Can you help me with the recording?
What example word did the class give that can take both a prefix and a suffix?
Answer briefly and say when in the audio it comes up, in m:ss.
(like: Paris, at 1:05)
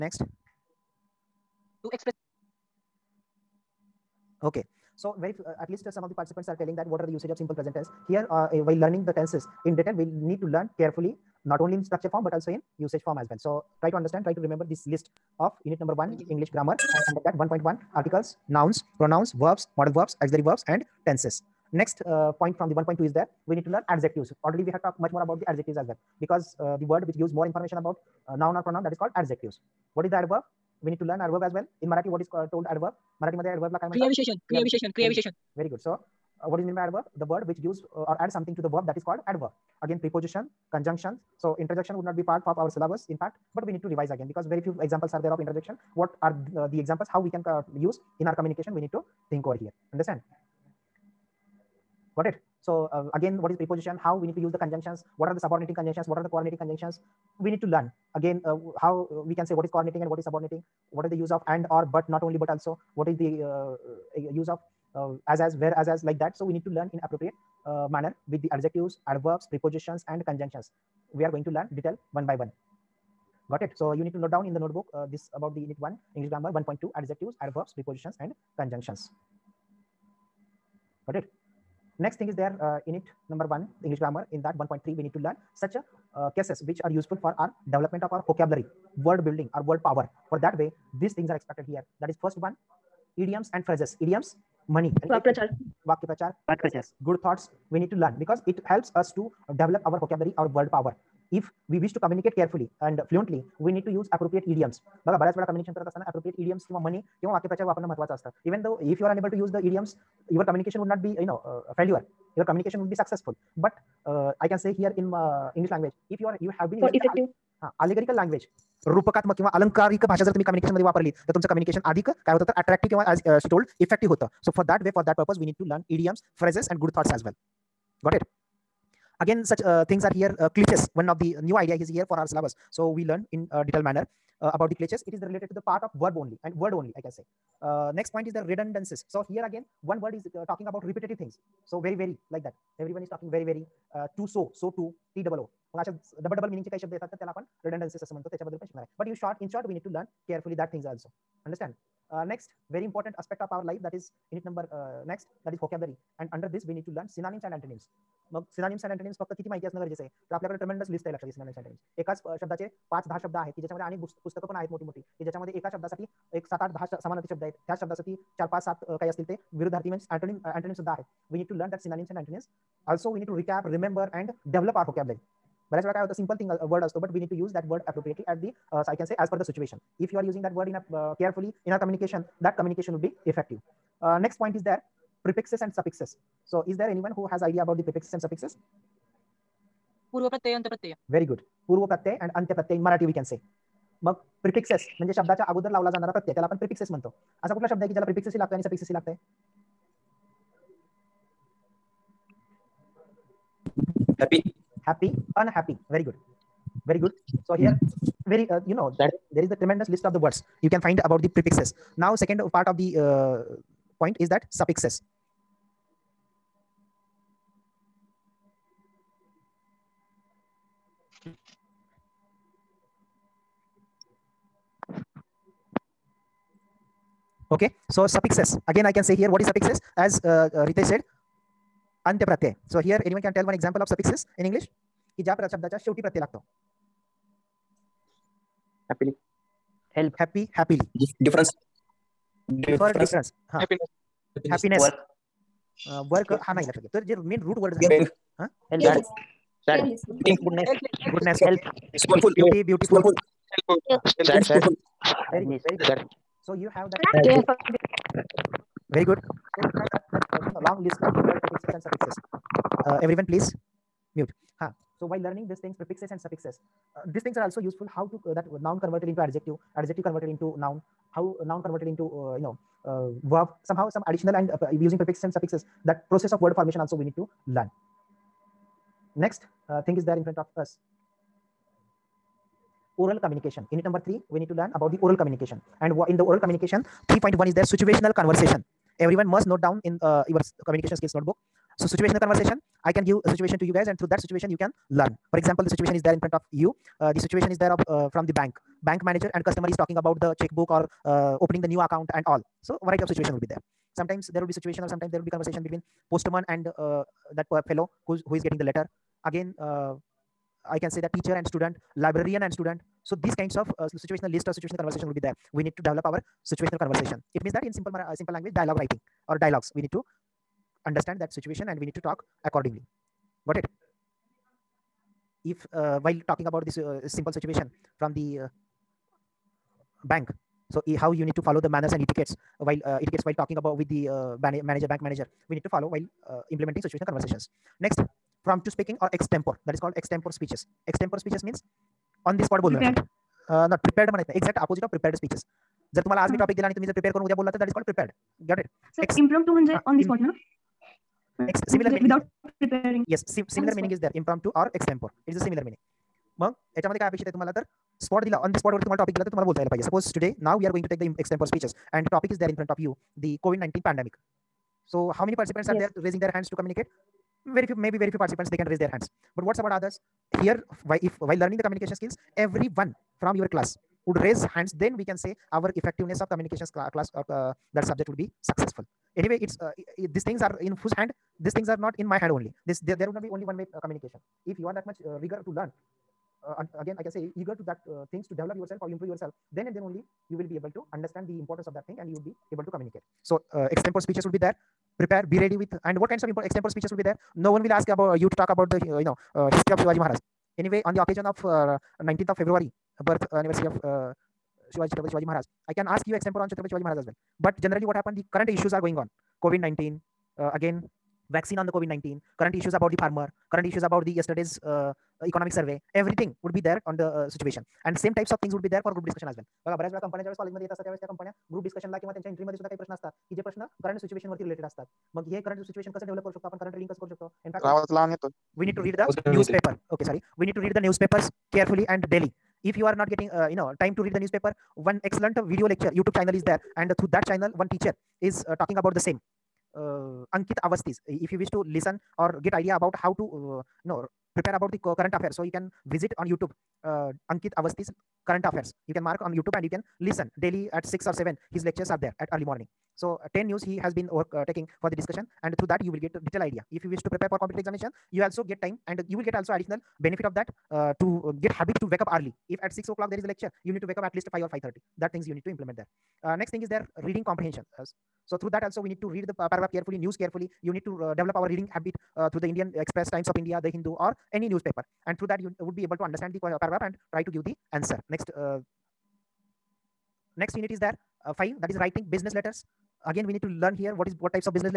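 happy, at 3:24.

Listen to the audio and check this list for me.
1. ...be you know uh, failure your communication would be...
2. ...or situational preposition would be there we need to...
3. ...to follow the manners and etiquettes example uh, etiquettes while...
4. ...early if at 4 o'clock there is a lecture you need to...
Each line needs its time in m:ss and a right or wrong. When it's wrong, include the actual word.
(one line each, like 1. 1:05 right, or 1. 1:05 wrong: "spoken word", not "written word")
1. 1:51 right
2. 5:14 wrong: "conversation", not "preposition"
3. 5:31 wrong: "while", not "example"
4. 7:42 wrong: "6", not "4".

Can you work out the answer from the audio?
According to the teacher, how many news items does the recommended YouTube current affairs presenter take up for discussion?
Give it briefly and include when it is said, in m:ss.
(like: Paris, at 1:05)
10, at 7:33.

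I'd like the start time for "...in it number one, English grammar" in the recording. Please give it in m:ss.
1:22.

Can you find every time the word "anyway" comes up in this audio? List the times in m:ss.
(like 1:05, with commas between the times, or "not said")
6:19, 6:40.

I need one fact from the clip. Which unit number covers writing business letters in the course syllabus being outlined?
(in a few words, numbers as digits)
5.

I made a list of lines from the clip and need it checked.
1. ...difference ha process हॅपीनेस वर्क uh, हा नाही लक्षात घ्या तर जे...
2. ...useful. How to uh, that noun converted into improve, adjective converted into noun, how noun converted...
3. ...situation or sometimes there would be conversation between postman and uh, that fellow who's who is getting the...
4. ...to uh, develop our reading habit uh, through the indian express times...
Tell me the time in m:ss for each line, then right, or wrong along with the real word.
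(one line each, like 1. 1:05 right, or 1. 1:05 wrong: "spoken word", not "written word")
1. 4:03 wrong: "happiness", not "process"
2. 4:27 wrong: "adjective", not "improve"
3. 5:04 right
4. 7:50 right.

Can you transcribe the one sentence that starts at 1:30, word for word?
For that way, these things are expected here.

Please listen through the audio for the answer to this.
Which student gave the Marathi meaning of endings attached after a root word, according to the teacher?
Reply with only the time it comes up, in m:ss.
3:50.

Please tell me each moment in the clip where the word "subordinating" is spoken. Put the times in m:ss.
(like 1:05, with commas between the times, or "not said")
0:55, 1:00.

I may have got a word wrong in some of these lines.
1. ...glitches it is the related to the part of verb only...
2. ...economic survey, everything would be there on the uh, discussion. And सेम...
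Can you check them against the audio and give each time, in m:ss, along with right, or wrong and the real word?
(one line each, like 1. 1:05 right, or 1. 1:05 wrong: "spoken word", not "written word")
1. 2:14 right
2. 6:55 wrong: "situation", not "discussion".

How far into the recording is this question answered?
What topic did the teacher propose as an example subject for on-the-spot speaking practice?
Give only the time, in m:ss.
6:03.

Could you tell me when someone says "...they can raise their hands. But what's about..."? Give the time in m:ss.
6:08.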